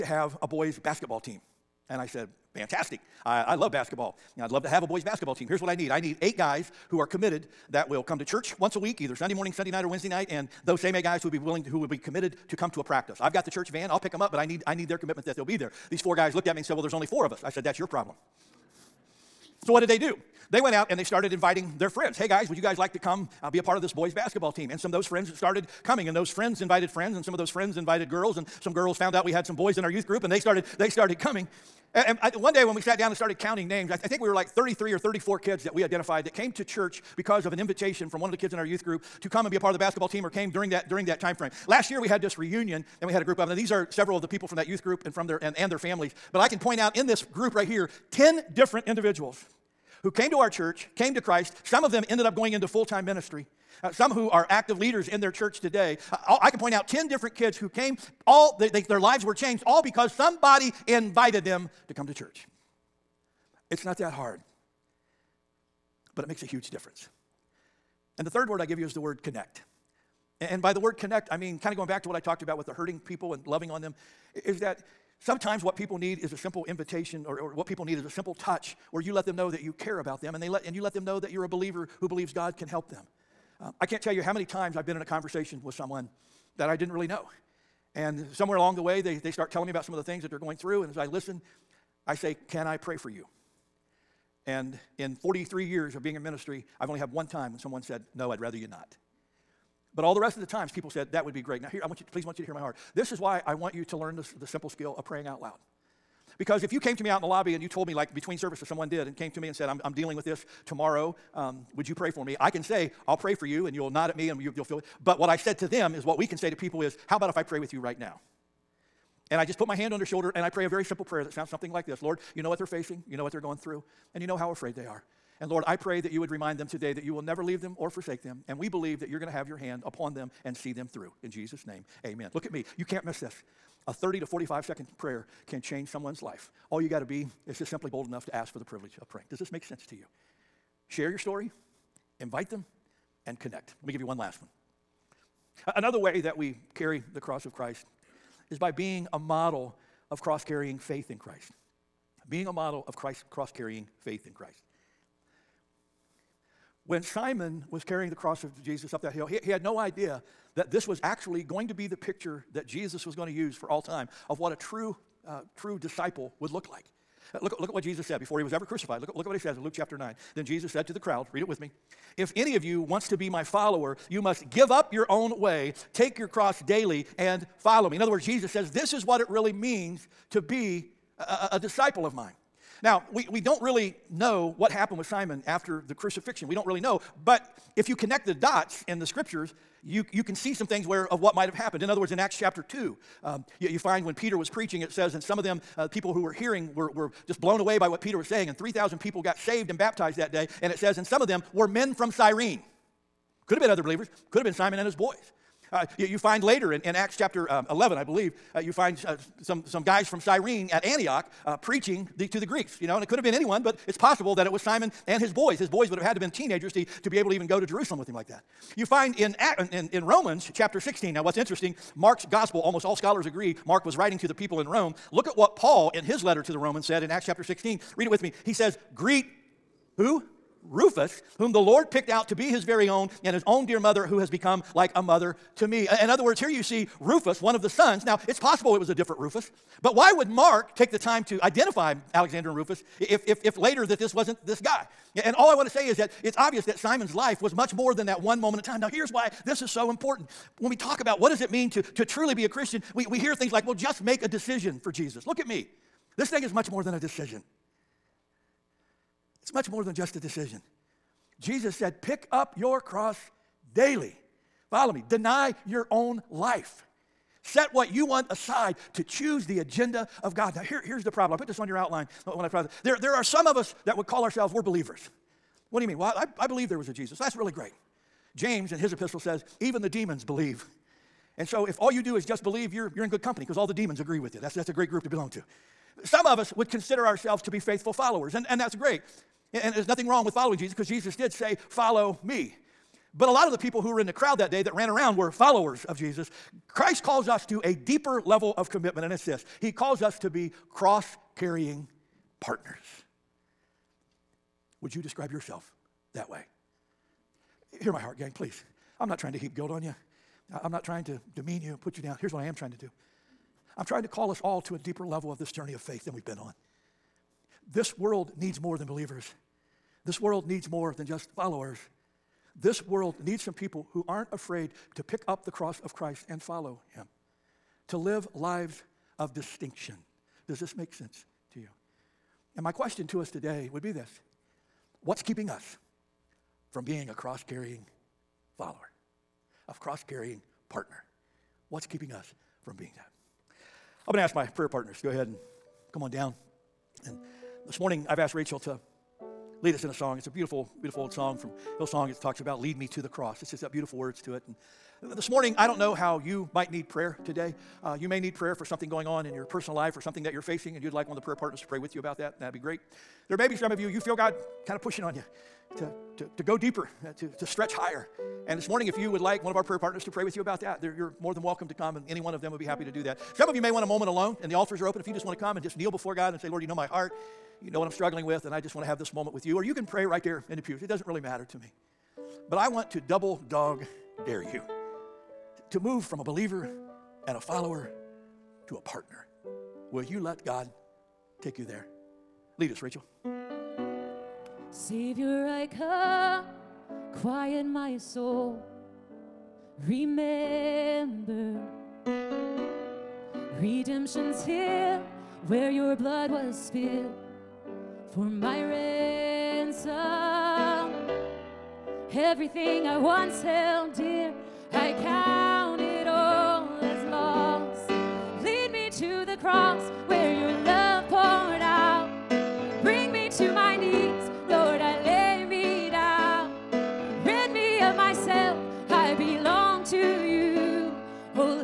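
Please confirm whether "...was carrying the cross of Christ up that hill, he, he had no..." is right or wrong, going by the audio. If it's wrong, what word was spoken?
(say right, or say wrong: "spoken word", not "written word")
wrong: "Jesus", not "Christ".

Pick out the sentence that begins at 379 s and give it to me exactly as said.
Or you can pray right there in the pews.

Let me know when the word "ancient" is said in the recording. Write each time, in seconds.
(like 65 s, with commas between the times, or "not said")
not said.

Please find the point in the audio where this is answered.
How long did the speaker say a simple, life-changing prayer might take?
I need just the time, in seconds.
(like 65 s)
133 s.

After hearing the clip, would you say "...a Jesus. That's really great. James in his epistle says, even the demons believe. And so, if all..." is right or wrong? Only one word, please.
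right.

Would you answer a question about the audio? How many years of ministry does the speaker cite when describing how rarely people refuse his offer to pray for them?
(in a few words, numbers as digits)
43.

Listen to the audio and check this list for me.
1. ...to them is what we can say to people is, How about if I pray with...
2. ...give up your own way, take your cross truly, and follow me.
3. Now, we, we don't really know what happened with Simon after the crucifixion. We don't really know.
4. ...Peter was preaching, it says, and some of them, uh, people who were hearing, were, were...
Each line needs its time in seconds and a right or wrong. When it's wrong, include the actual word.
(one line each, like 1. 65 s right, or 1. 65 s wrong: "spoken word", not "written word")
1. 115 s right
2. 174 s wrong: "daily", not "truly"
3. 182 s right
4. 194 s right.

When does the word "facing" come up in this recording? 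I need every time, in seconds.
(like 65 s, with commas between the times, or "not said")
122 s, 360 s.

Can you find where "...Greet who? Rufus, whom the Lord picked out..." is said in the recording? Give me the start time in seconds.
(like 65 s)
228 s.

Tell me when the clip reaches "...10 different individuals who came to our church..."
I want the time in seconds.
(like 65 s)
48 s.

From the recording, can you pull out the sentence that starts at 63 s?
It's not that hard, but it makes a huge difference.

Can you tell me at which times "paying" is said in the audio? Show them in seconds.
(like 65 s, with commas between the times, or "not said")
not said.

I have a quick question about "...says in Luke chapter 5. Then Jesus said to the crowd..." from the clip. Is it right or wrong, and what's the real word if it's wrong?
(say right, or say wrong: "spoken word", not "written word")
wrong: "9", not "5".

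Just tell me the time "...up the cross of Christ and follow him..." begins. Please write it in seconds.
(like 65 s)
325 s.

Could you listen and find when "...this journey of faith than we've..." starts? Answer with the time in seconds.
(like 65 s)
315 s.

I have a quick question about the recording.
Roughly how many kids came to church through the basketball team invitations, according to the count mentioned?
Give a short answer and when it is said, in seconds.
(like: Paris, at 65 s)
33 or 34, at 34 s.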